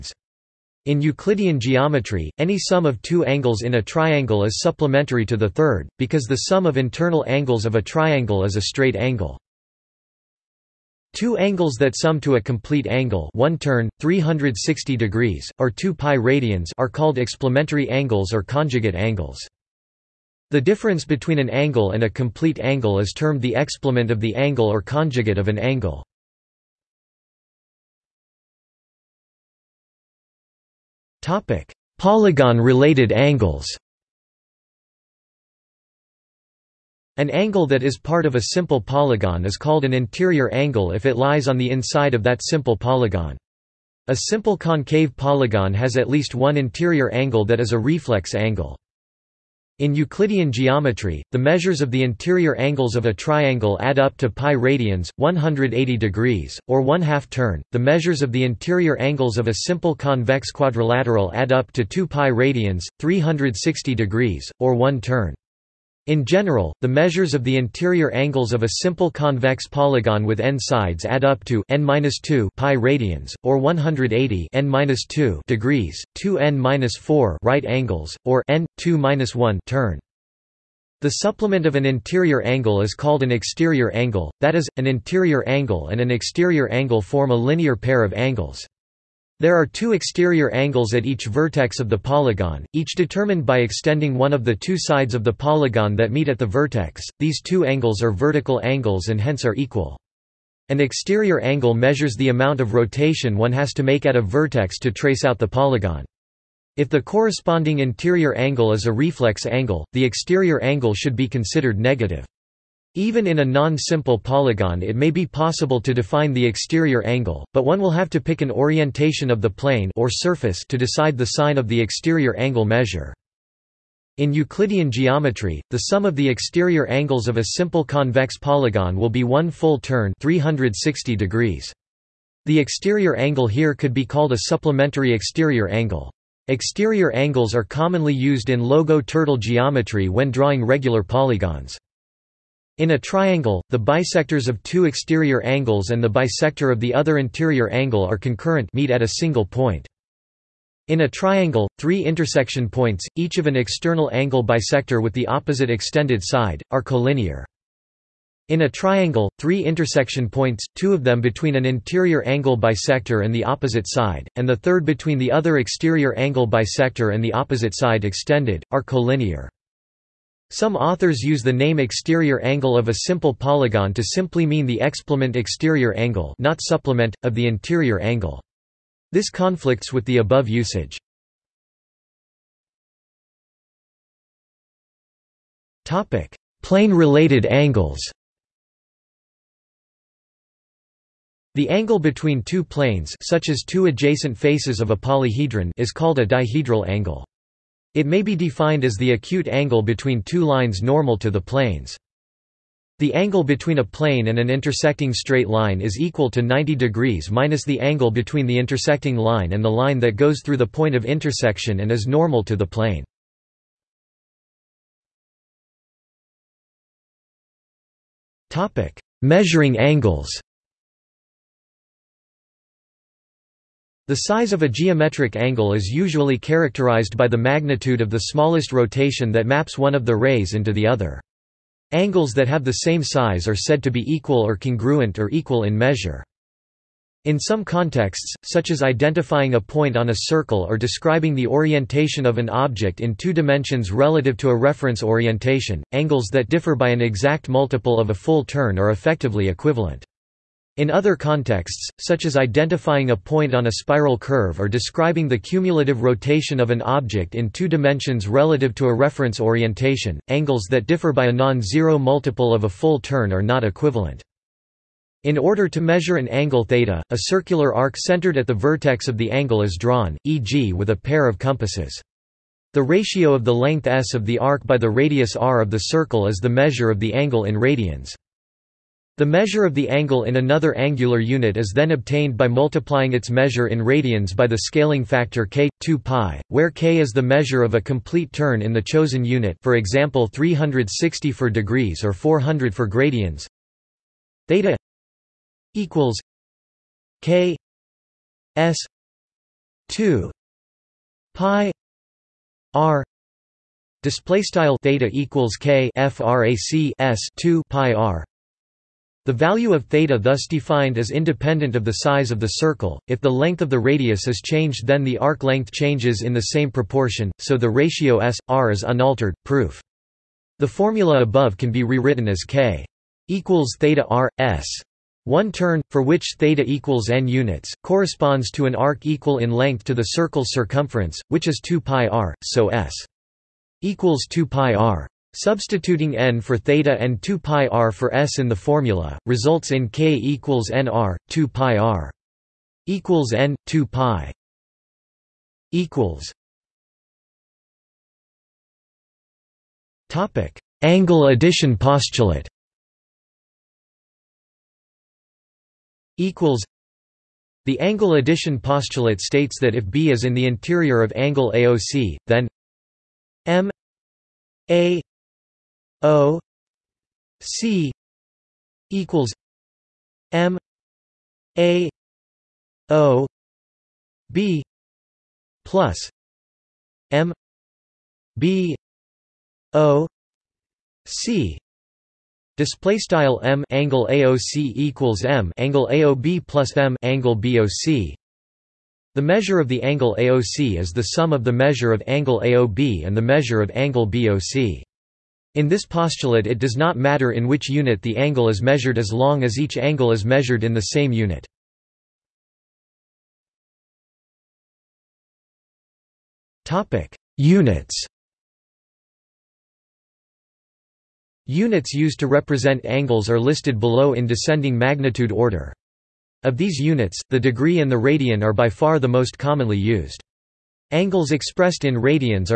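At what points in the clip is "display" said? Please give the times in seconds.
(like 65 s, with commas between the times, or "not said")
304 s, 382 s.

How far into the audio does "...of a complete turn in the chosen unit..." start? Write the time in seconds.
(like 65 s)
287 s.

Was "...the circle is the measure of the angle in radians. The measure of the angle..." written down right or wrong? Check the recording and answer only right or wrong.
right.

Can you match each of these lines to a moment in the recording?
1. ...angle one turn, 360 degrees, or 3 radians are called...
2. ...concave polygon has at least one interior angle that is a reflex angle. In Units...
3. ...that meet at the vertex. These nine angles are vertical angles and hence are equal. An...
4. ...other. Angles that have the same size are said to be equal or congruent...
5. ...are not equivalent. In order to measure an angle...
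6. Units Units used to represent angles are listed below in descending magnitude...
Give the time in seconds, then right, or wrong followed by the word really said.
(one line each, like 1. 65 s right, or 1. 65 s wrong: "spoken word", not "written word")
1. 12 s wrong: "2", not "3"
2. 44 s wrong: "Euclidean", not "Units"
3. 95 s wrong: "two", not "nine"
4. 230 s right
5. 263 s right
6. 407 s right.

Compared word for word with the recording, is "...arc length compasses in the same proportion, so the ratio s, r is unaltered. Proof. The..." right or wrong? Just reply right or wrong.
wrong.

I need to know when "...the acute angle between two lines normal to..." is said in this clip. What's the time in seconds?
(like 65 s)
198 s.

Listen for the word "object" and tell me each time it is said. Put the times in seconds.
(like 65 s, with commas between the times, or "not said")
242 s, 256 s.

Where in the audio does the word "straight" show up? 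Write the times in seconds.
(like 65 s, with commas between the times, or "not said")
8 s, 205 s.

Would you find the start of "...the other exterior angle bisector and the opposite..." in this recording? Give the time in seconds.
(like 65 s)
165 s.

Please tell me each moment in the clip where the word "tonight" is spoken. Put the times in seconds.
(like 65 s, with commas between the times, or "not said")
not said.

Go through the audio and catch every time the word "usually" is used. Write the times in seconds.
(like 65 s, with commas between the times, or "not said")
225 s.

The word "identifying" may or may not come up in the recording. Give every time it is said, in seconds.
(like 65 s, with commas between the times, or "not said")
238 s, 252 s.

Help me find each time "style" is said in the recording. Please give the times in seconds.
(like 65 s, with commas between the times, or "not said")
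304 s, 382 s.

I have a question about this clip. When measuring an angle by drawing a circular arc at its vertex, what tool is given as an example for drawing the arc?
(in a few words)
a pair of compasses.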